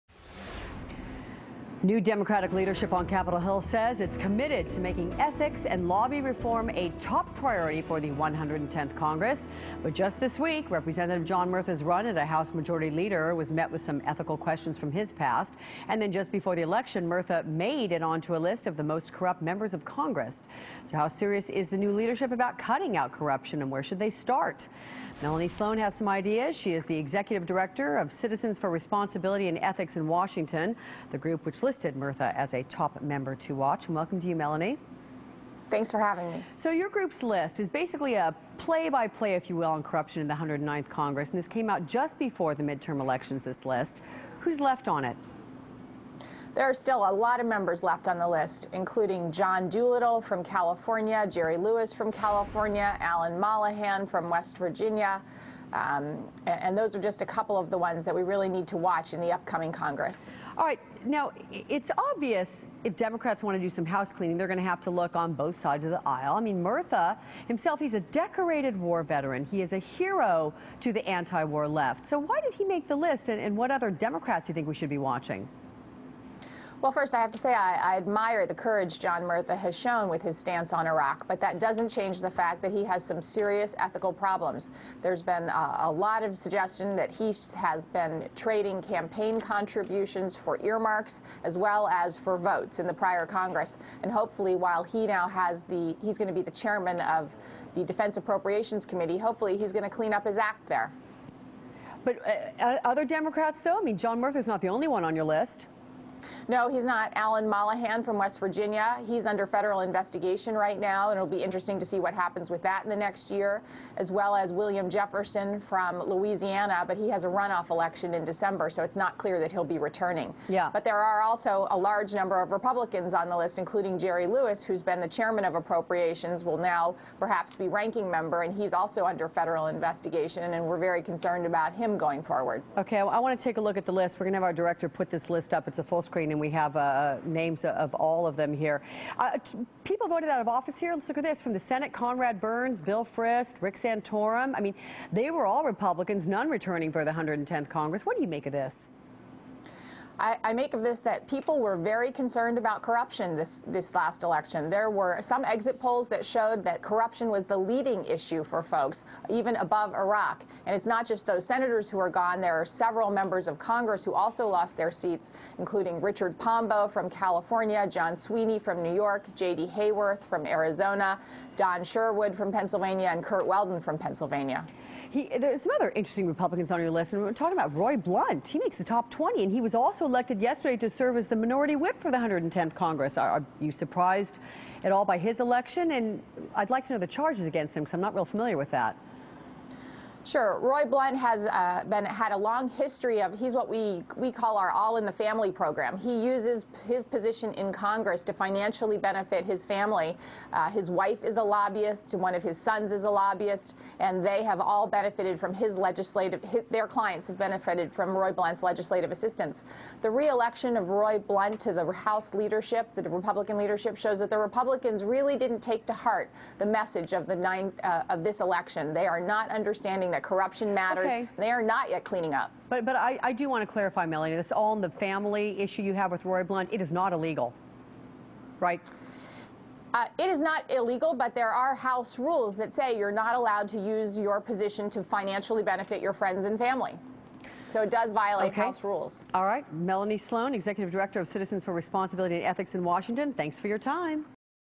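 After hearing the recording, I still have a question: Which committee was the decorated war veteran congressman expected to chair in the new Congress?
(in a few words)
Defense Appropriations Committee.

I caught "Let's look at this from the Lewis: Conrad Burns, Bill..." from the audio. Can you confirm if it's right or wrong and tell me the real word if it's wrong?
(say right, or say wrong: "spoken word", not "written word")
wrong: "Senate", not "Lewis".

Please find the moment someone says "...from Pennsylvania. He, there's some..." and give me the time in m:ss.
2:53.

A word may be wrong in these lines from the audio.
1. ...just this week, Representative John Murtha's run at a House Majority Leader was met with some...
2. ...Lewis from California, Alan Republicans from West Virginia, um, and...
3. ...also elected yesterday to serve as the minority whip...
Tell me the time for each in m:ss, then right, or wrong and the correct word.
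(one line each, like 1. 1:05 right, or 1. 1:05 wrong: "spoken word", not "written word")
1. 0:09 right
2. 0:51 wrong: "Mollohan", not "Republicans"
3. 3:00 right.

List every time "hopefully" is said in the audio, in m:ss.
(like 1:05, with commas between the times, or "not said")
1:34, 1:39.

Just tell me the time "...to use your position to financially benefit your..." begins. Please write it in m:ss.
3:53.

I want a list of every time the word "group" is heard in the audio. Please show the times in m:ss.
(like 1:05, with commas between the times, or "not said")
0:31, 0:36.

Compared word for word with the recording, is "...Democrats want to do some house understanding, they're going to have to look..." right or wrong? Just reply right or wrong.
wrong.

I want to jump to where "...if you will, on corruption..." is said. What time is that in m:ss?
0:39.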